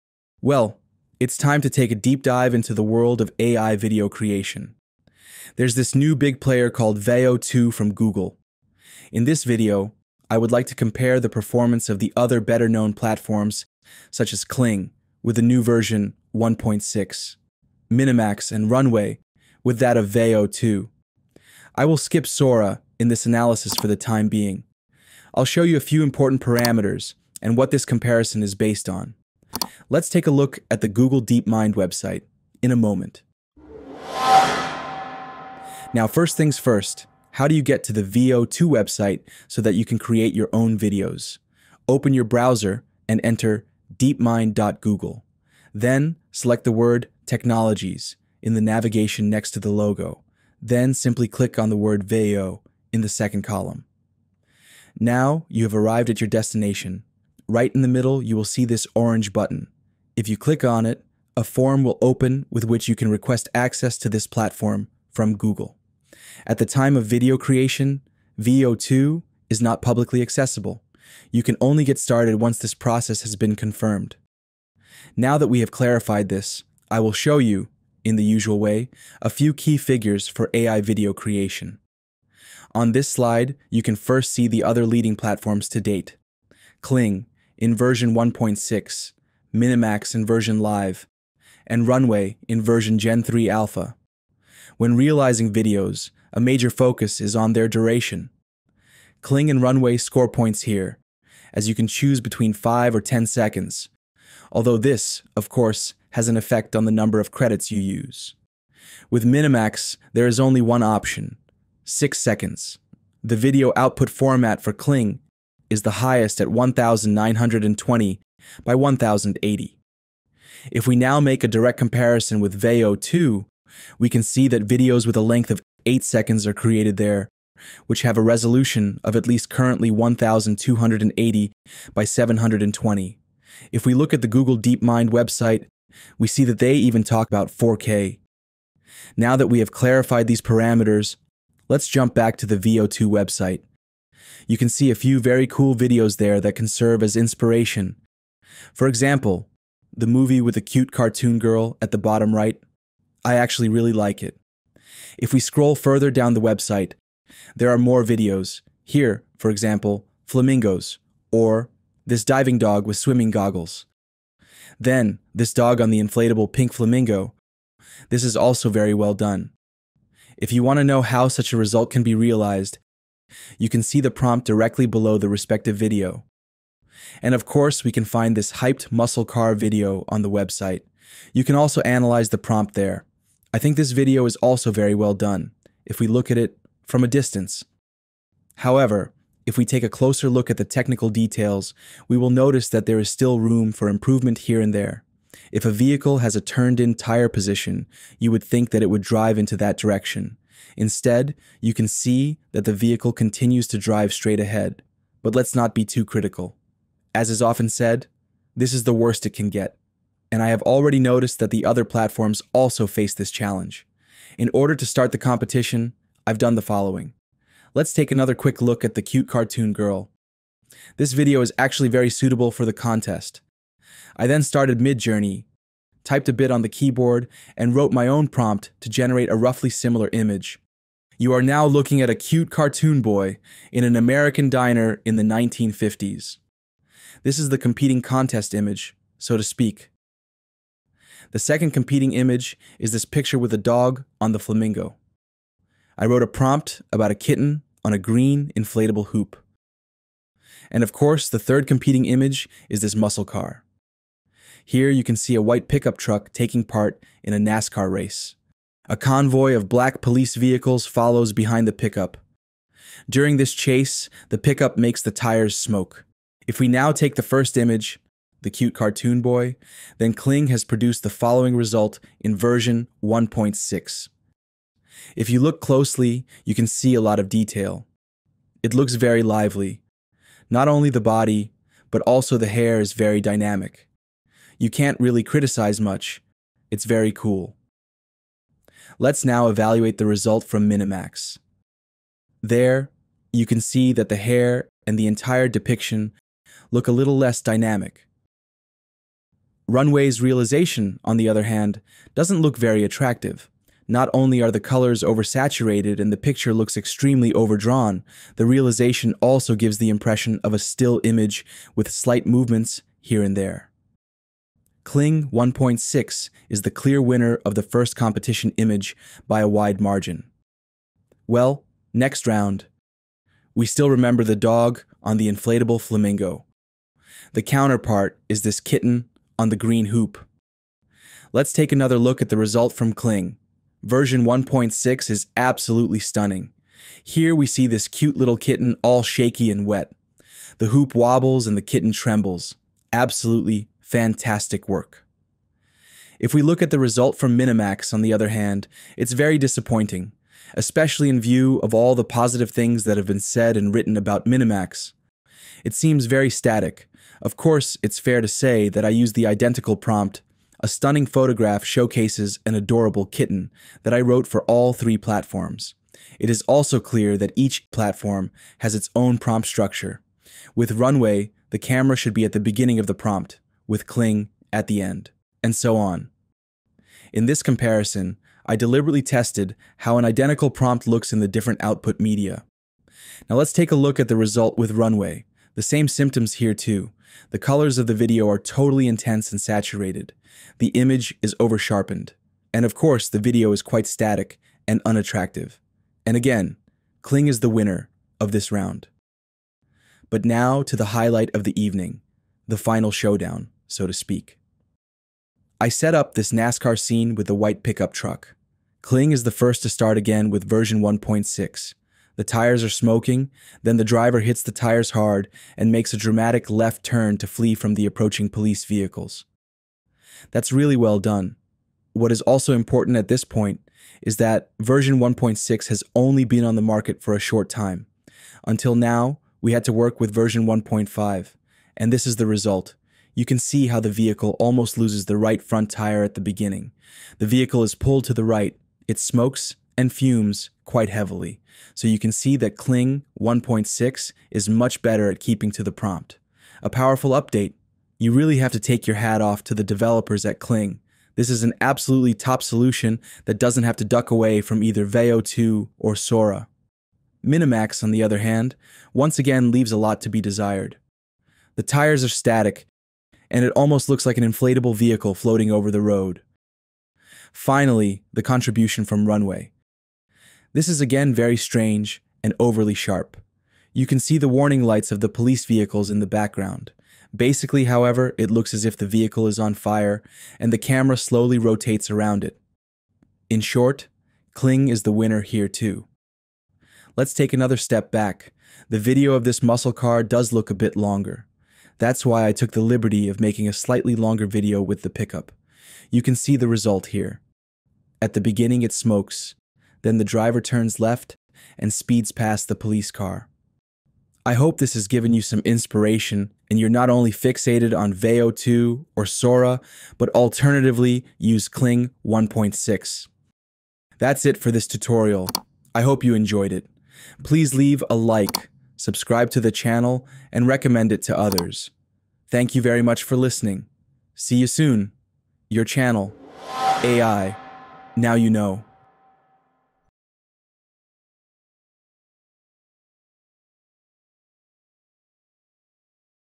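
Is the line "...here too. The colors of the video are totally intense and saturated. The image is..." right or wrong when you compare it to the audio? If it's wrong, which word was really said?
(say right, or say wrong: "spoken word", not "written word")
right.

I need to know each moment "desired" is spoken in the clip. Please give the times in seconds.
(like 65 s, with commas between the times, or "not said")
460 s.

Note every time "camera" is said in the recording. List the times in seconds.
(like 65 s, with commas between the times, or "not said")
371 s, 480 s.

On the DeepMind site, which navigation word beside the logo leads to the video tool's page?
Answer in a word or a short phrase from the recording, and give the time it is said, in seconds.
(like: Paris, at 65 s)
Technologies, at 47 s.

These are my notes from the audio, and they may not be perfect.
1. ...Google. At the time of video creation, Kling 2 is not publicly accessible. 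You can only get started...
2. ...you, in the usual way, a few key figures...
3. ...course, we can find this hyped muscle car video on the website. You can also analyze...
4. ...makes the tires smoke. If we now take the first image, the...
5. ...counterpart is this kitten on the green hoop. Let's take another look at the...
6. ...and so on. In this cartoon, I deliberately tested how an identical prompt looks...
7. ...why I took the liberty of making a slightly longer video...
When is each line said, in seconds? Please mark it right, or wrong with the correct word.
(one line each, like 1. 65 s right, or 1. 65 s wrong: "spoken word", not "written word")
1. 65 s wrong: "Veo", not "Kling"
2. 77 s right
3. 177 s right
4. 264 s right
5. 327 s right
6. 375 s wrong: "comparison", not "cartoon"
7. 492 s right.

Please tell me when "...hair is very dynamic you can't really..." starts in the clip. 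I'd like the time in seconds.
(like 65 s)
282 s.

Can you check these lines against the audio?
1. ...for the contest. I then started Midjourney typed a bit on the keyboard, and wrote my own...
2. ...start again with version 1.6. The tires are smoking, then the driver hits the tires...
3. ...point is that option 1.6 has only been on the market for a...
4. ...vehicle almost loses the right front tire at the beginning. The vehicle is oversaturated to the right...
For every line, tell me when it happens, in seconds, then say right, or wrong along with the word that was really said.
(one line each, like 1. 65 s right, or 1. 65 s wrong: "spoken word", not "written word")
1. 222 s right
2. 409 s right
3. 423 s wrong: "version", not "option"
4. 433 s wrong: "pulled", not "oversaturated".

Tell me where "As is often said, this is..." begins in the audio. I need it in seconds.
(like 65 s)
207 s.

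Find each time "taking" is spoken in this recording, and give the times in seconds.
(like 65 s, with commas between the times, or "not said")
256 s.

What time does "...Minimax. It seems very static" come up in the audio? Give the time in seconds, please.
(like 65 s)
354 s.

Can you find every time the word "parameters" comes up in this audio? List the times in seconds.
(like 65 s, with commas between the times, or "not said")
26 s, 140 s.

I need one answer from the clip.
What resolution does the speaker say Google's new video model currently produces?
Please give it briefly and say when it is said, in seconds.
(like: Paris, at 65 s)
1280 by 720, at 129 s.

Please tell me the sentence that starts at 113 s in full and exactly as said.
The video output format for Kling is the highest at 1920 by 1080.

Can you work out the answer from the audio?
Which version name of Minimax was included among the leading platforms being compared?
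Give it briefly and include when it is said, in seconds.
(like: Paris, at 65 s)
Live, at 90 s.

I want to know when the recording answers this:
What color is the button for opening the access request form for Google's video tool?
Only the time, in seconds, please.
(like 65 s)
58 s.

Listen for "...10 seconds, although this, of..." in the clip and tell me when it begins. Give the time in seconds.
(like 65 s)
103 s.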